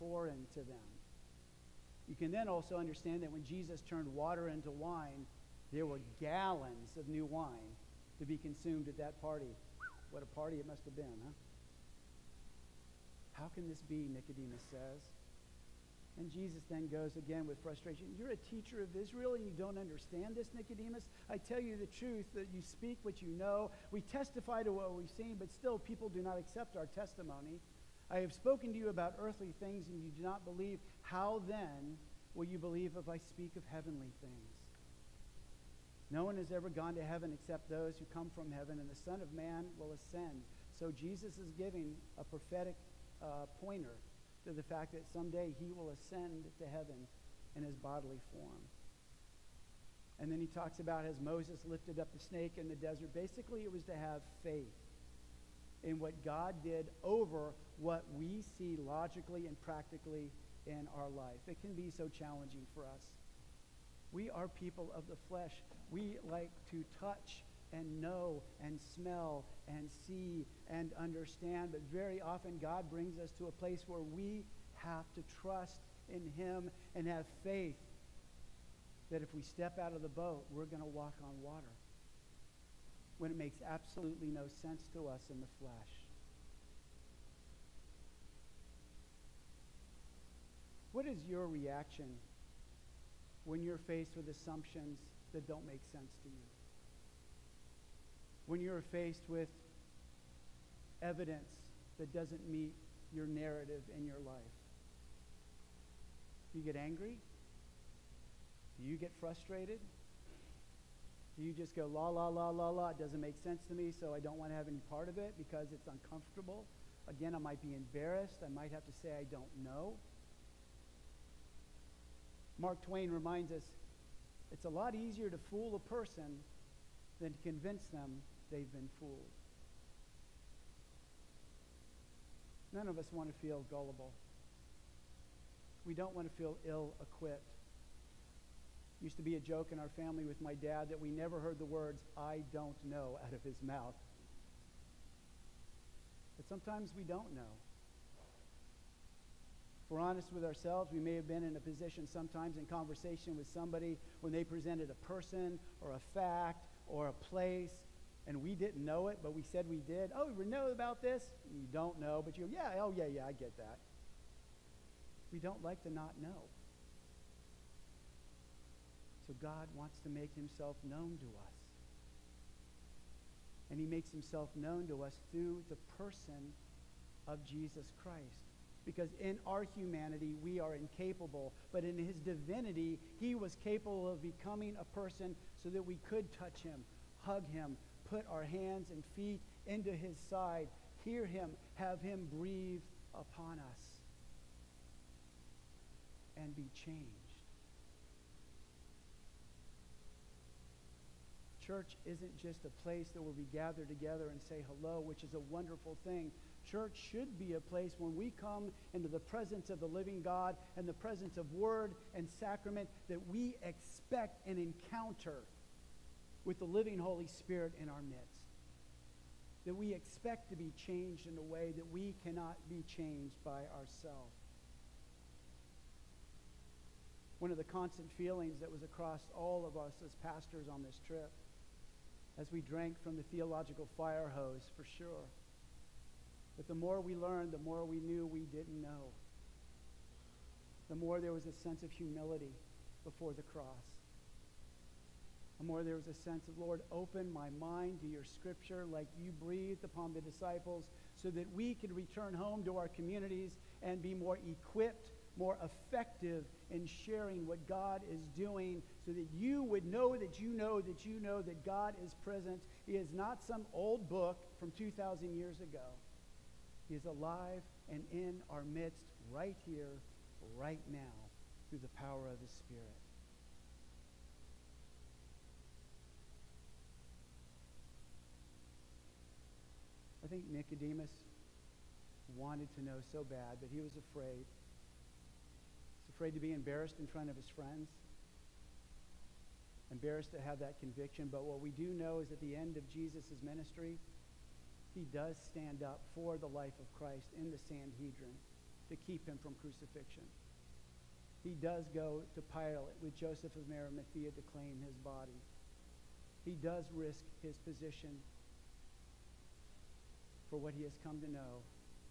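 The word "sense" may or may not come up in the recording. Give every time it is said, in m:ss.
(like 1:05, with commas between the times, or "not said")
1:24, 1:35, 1:53, 4:01, 4:06.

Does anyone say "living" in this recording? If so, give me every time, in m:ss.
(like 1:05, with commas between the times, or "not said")
3:29, 3:36.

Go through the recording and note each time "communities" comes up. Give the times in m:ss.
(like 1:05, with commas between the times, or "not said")
4:12.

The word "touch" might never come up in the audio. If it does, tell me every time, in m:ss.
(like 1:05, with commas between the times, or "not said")
1:06, 3:06.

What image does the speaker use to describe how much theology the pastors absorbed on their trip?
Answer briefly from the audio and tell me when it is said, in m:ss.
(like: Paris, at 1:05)
theological fire hose, at 3:53.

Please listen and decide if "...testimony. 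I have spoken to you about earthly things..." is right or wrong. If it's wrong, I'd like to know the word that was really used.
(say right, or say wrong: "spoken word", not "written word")
right.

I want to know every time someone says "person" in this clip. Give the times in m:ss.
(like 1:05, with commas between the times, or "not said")
2:05, 2:35, 2:55, 3:04.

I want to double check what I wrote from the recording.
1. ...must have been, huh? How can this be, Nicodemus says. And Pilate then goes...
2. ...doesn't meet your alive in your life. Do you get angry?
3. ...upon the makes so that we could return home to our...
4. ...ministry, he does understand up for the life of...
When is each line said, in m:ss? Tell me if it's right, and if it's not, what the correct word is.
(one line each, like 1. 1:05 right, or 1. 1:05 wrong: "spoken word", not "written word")
1. 0:10 wrong: "Jesus", not "Pilate"
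2. 1:42 wrong: "narrative", not "alive"
3. 4:09 wrong: "disciples", not "makes"
4. 4:53 wrong: "stand", not "understand".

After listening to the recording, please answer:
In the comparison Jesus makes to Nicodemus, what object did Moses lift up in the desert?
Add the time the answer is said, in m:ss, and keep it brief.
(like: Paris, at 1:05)
snake, at 0:52.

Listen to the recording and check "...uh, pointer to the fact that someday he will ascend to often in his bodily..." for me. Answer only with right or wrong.
wrong.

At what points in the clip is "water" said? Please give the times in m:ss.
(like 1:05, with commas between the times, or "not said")
0:04, 1:21.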